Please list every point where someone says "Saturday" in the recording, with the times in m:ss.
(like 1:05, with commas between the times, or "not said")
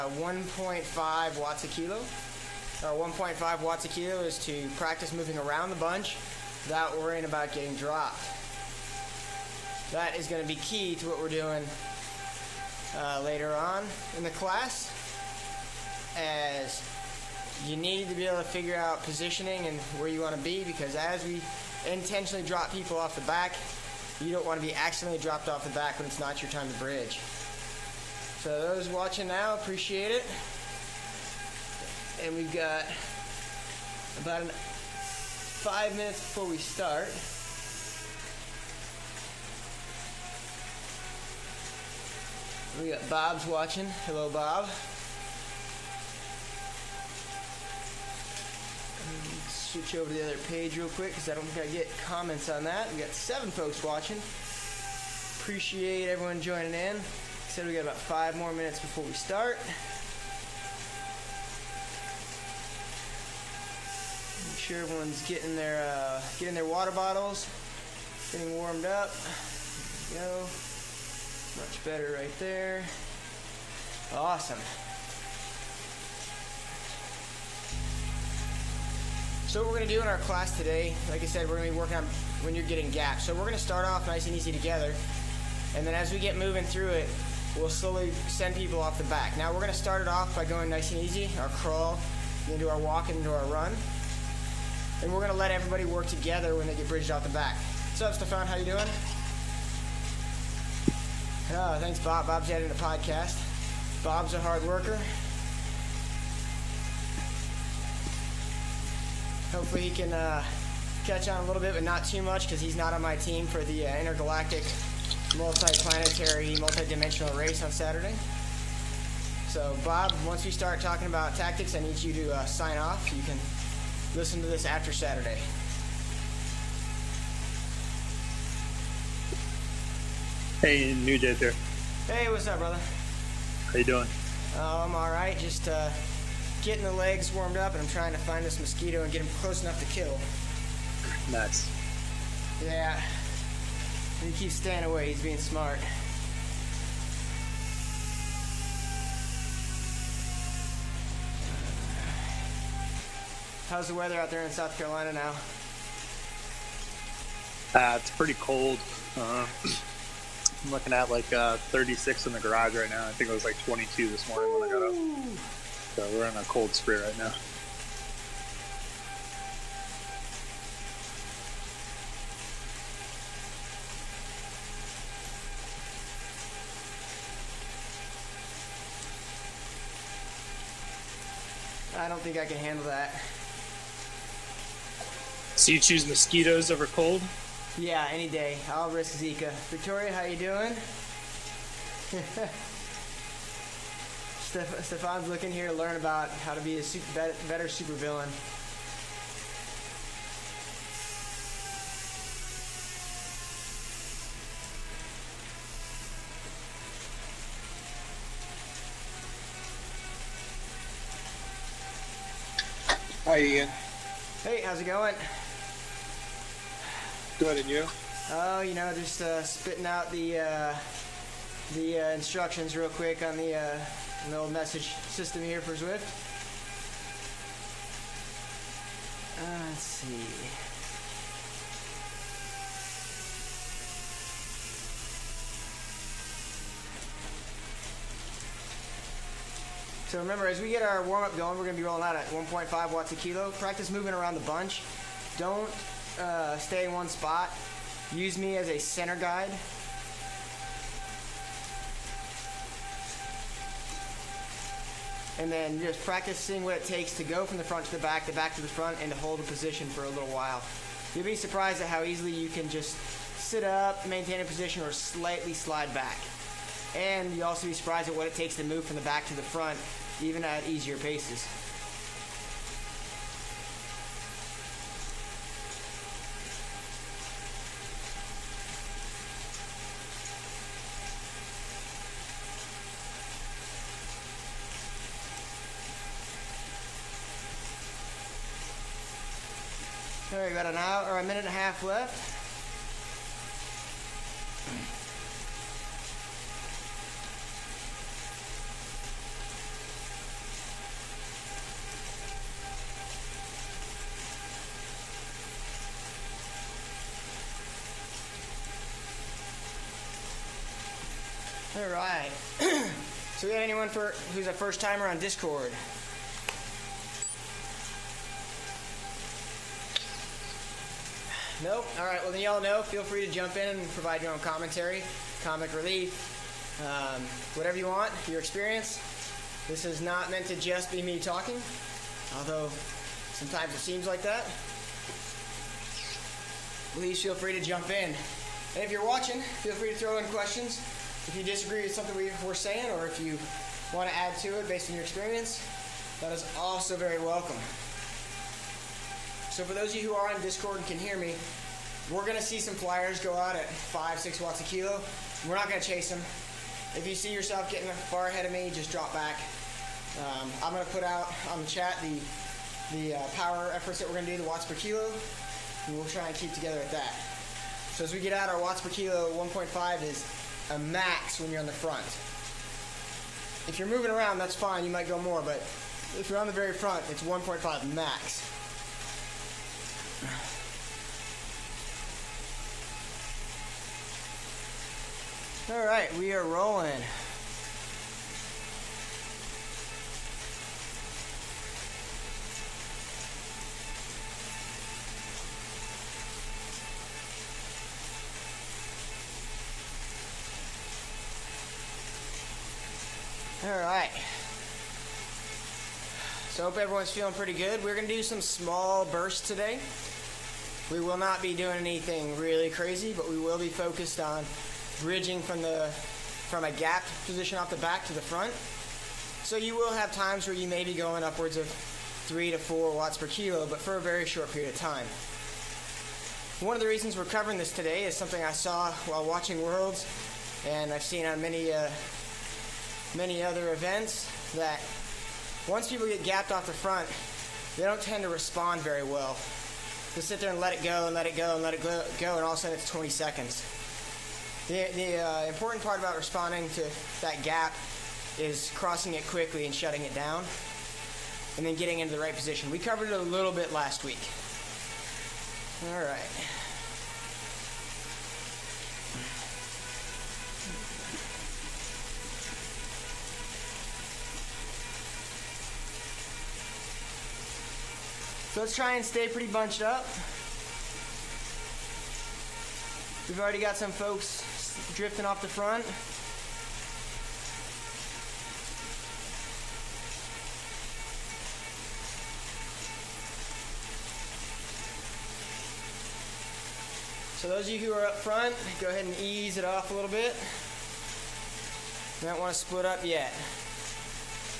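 1:57, 2:04.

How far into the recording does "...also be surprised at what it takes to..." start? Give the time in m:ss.
4:27.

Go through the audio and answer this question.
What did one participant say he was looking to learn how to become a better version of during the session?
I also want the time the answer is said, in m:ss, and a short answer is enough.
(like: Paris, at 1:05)
supervillain, at 3:17.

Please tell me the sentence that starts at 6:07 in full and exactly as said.
So as we get out, our watts per kilo 1.5 is a max when you're on the front.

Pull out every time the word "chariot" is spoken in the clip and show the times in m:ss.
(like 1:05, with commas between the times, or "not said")
not said.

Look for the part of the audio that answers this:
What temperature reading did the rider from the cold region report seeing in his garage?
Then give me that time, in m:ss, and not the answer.
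2:41.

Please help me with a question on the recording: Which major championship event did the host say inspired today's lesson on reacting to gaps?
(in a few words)
Worlds.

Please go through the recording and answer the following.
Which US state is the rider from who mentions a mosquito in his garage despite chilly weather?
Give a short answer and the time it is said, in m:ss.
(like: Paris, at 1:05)
South Carolina, at 2:34.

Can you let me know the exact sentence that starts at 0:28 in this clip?
So those watching now, appreciate it.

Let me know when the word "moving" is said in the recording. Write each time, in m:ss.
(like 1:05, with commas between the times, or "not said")
0:05, 1:26, 4:03, 6:13.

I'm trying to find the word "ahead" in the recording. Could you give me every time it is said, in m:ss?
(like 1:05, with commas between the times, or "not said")
5:58, 8:08.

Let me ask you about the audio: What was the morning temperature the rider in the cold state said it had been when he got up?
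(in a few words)
22.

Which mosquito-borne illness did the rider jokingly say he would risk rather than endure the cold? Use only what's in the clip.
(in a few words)
Zika.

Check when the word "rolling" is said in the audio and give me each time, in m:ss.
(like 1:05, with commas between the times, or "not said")
4:01, 6:26.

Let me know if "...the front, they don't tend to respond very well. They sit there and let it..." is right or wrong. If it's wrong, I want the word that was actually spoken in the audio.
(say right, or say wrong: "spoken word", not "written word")
right.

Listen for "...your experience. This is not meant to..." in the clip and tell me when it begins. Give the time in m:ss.
5:28.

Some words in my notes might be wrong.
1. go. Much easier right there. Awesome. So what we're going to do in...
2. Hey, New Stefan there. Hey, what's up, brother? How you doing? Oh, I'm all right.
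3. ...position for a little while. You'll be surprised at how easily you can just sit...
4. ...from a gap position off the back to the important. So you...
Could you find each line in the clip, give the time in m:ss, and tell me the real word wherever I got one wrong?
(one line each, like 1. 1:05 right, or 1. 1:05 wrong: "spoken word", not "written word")
1. 1:10 wrong: "better", not "easier"
2. 2:10 wrong: "Jet", not "Stefan"
3. 4:19 right
4. 6:56 wrong: "front", not "important".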